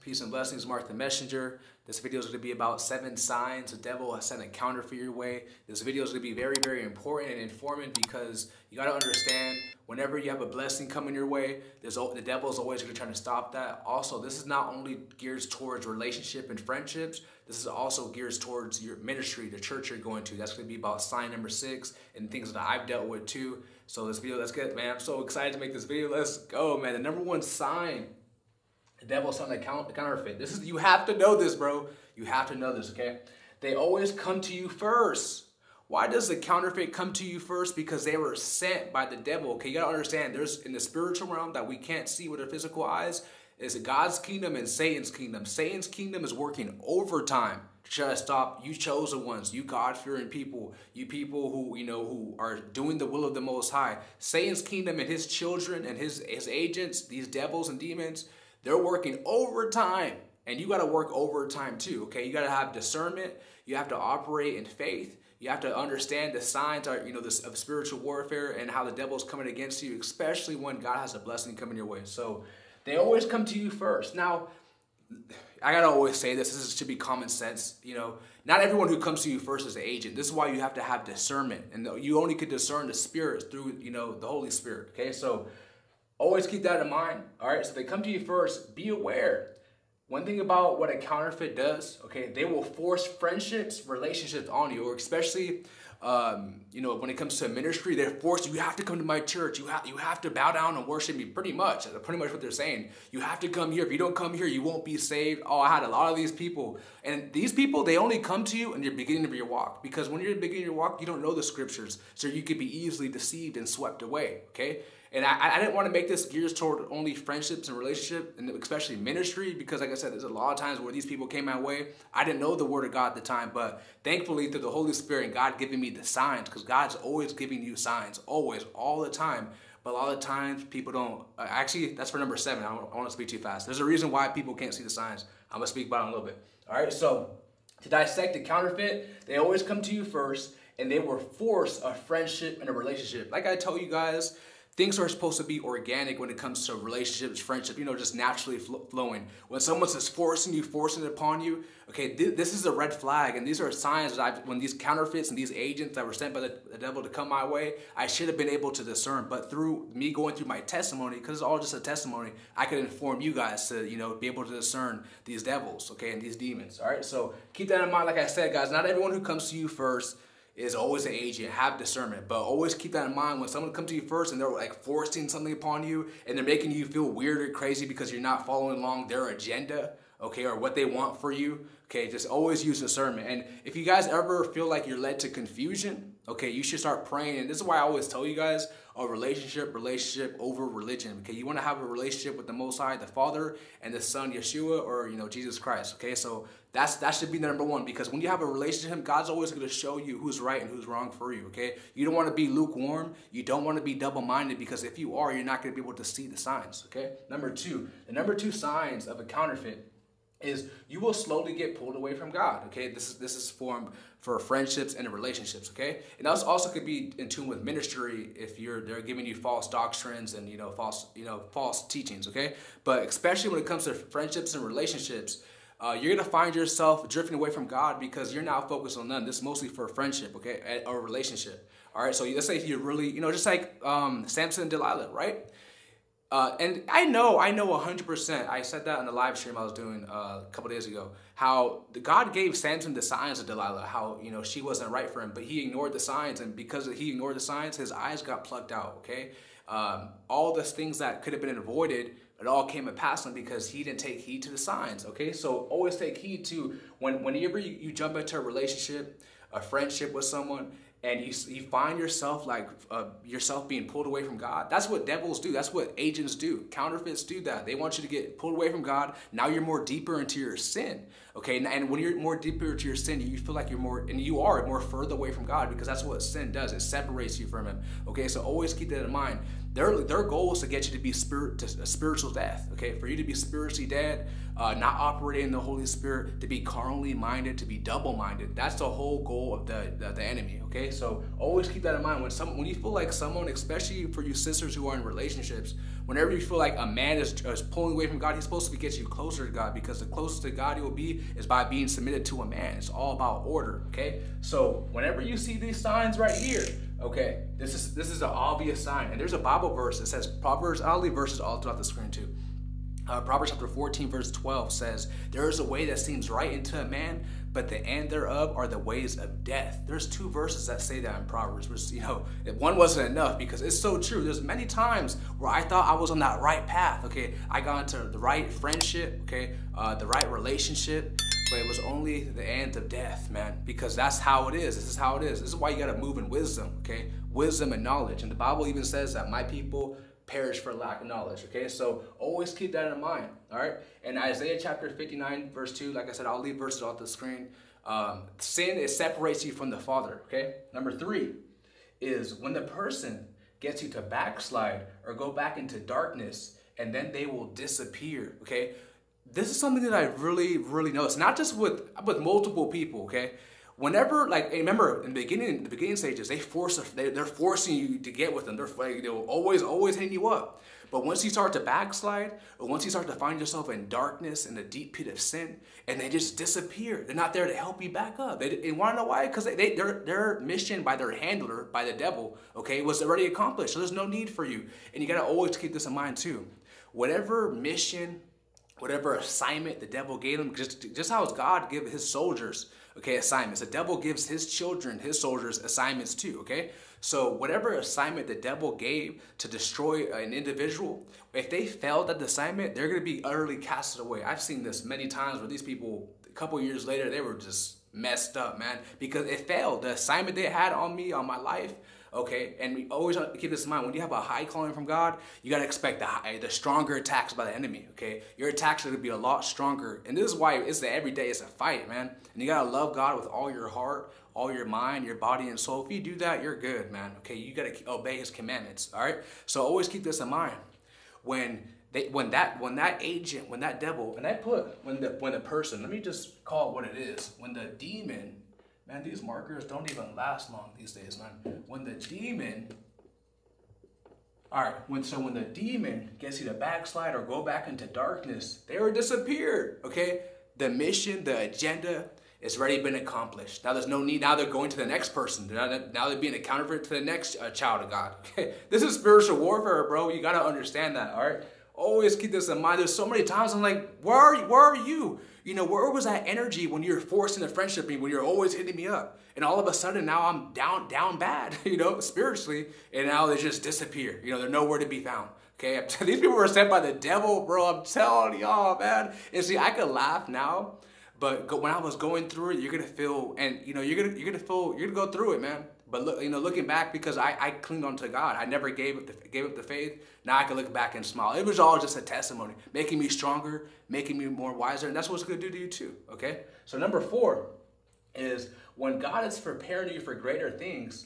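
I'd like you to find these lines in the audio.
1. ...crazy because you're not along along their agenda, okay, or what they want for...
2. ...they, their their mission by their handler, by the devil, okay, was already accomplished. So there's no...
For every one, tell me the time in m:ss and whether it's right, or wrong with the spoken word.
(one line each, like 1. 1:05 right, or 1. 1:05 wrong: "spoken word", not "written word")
1. 2:57 wrong: "following", not "along"
2. 6:19 right.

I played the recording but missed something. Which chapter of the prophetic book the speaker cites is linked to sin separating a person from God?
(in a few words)
Chapter 59.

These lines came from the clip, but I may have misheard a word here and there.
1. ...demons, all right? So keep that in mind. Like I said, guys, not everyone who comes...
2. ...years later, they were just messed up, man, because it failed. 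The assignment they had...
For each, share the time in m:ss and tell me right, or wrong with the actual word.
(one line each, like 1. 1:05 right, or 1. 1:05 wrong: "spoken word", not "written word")
1. 2:46 right
2. 6:46 right.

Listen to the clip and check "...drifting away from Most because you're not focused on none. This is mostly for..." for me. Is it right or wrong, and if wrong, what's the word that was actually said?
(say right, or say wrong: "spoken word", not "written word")
wrong: "God", not "Most".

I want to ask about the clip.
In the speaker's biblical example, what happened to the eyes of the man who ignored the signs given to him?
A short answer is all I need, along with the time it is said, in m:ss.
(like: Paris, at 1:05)
Plucked out, at 4:08.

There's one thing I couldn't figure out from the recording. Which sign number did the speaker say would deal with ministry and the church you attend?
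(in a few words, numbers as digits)
6.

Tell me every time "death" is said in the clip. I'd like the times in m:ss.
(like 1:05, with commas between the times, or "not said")
4:42, 5:19, 5:32.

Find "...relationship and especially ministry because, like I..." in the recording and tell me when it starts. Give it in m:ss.
1:57.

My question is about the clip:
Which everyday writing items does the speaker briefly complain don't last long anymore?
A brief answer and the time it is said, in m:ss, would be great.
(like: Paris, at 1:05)
Markers, at 7:19.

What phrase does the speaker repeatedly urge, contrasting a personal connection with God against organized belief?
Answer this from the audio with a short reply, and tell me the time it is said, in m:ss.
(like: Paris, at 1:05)
Relationship over religion, at 3:09.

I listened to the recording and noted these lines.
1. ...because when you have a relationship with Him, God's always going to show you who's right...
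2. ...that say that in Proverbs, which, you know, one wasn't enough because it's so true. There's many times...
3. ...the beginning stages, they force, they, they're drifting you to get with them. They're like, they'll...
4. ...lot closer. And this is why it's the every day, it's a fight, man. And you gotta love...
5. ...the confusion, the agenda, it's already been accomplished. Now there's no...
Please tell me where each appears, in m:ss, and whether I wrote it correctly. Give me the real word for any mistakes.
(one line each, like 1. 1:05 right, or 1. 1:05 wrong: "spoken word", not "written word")
1. 3:17 right
2. 5:20 right
3. 6:05 wrong: "forcing", not "drifting"
4. 6:59 wrong: "stronger", not "closer"
5. 7:30 wrong: "mission", not "confusion".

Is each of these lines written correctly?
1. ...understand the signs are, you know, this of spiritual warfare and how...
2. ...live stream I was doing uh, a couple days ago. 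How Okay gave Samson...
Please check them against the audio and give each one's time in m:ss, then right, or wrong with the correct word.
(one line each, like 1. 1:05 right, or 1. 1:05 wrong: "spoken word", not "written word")
1. 1:05 right
2. 3:59 wrong: "God", not "Okay".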